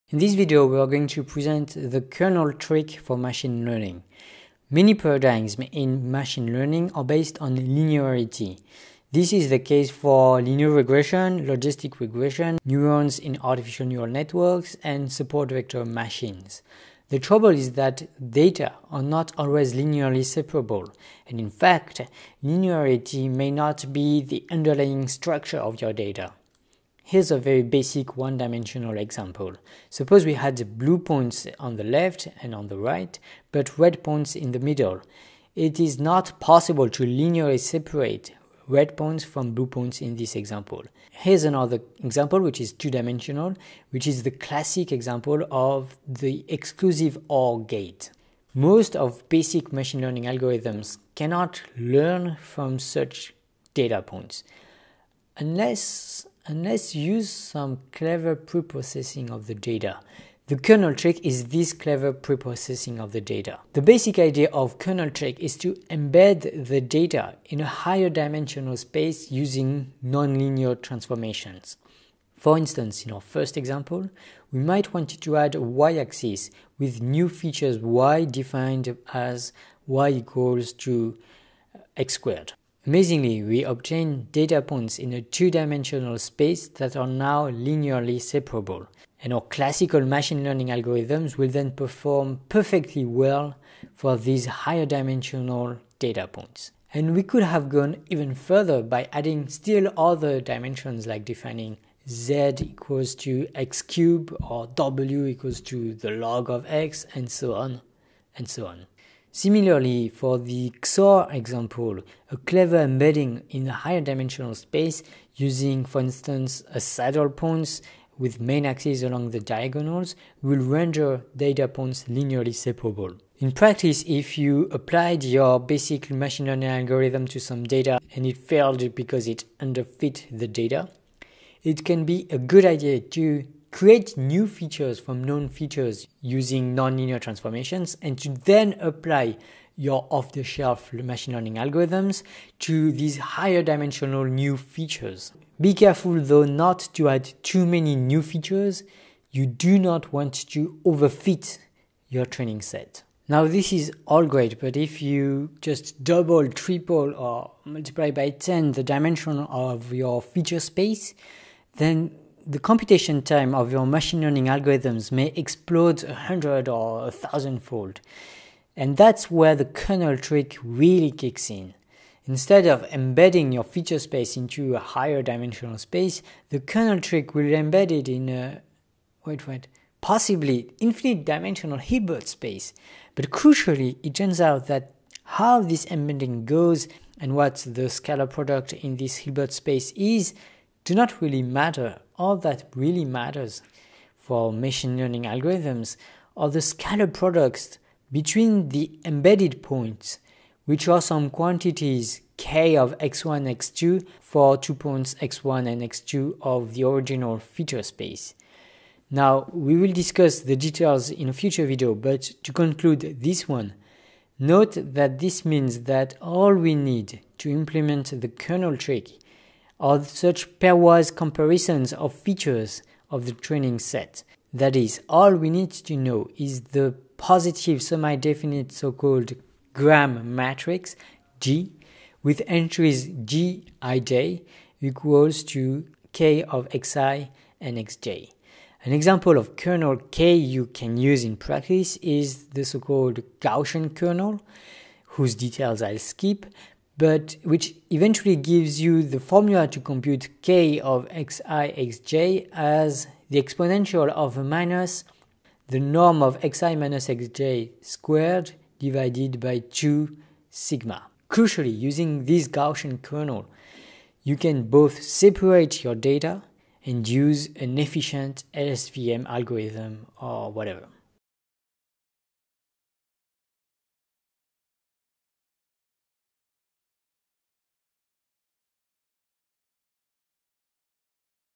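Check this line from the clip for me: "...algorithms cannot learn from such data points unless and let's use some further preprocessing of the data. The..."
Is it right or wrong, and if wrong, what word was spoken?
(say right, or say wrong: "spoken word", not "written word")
wrong: "clever", not "further".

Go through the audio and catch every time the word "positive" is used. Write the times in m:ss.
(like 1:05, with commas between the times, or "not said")
3:47.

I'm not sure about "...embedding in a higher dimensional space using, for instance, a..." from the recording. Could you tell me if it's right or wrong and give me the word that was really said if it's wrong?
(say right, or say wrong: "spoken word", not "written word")
right.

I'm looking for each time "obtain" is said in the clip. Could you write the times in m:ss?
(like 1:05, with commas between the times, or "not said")
1:23.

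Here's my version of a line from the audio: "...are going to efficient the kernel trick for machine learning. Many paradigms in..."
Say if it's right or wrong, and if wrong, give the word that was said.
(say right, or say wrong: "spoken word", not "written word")
wrong: "present", not "efficient".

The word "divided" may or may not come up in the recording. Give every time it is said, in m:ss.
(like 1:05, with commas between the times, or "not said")
4:18.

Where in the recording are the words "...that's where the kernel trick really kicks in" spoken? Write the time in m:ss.
2:48.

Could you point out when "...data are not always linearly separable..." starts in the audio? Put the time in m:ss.
0:18.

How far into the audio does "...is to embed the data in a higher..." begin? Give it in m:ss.
1:05.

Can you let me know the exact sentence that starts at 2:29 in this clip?
You do not want to overfit your training set.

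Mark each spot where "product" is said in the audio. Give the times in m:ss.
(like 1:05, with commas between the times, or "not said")
3:08, 3:17.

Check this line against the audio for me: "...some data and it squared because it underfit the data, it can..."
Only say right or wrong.
wrong.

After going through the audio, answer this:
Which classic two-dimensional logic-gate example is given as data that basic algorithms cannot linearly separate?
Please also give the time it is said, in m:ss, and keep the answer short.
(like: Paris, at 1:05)
exclusive OR gate, at 0:46.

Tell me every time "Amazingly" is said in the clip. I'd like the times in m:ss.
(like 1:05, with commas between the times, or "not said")
1:22.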